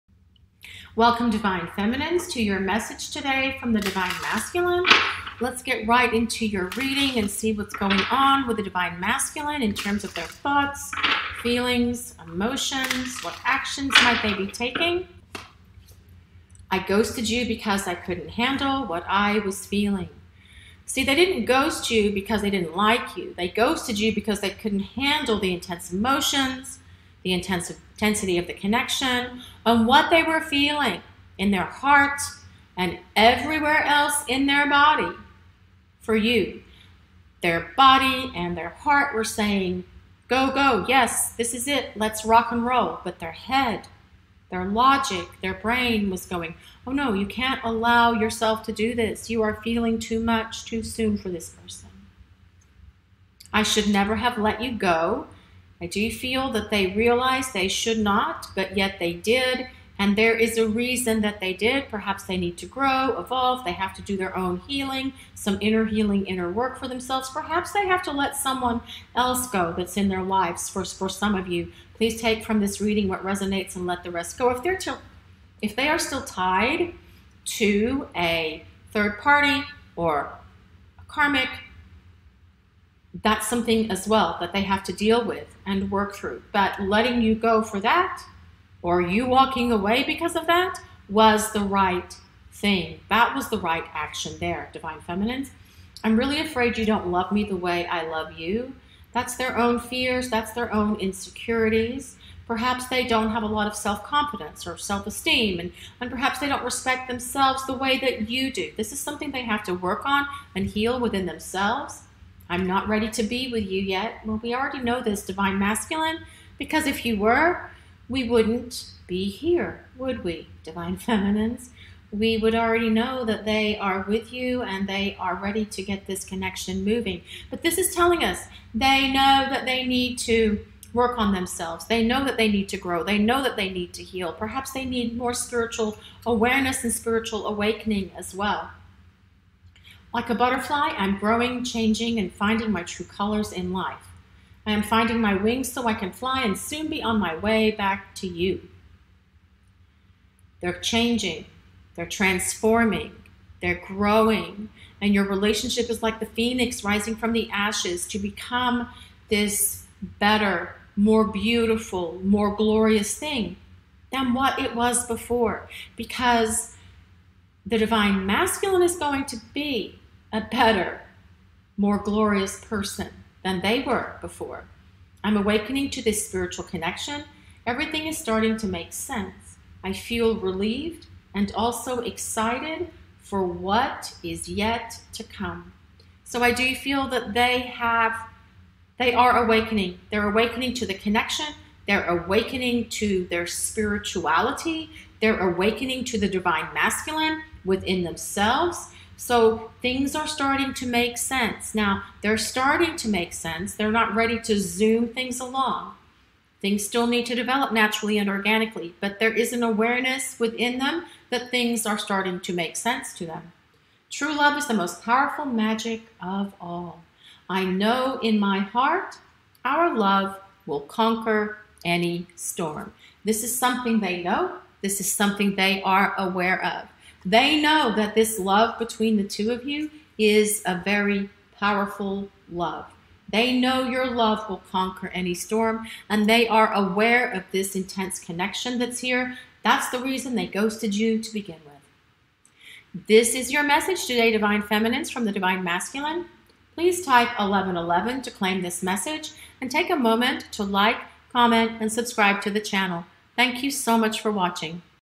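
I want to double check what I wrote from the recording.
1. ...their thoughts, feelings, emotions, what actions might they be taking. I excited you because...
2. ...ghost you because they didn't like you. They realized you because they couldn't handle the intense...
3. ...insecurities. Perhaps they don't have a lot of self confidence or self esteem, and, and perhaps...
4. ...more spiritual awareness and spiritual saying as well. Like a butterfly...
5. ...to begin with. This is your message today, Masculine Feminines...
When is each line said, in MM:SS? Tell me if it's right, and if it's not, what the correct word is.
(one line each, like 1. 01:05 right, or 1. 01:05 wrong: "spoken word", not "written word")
1. 00:10 wrong: "ghosted", not "excited"
2. 00:21 wrong: "ghosted", not "realized"
3. 01:40 right
4. 02:15 wrong: "awakening", not "saying"
5. 04:01 wrong: "Divine", not "Masculine".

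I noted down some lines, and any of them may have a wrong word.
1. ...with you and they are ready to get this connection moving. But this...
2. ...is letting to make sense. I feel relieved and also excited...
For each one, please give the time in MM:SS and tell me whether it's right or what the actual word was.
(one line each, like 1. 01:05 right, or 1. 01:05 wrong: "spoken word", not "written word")
1. 02:04 right
2. 02:58 wrong: "starting", not "letting".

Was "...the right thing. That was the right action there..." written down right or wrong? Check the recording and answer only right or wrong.
right.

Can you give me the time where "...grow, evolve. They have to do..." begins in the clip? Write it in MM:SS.
01:02.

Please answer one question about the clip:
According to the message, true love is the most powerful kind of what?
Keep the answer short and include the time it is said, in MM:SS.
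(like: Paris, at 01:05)
Magic, at 03:35.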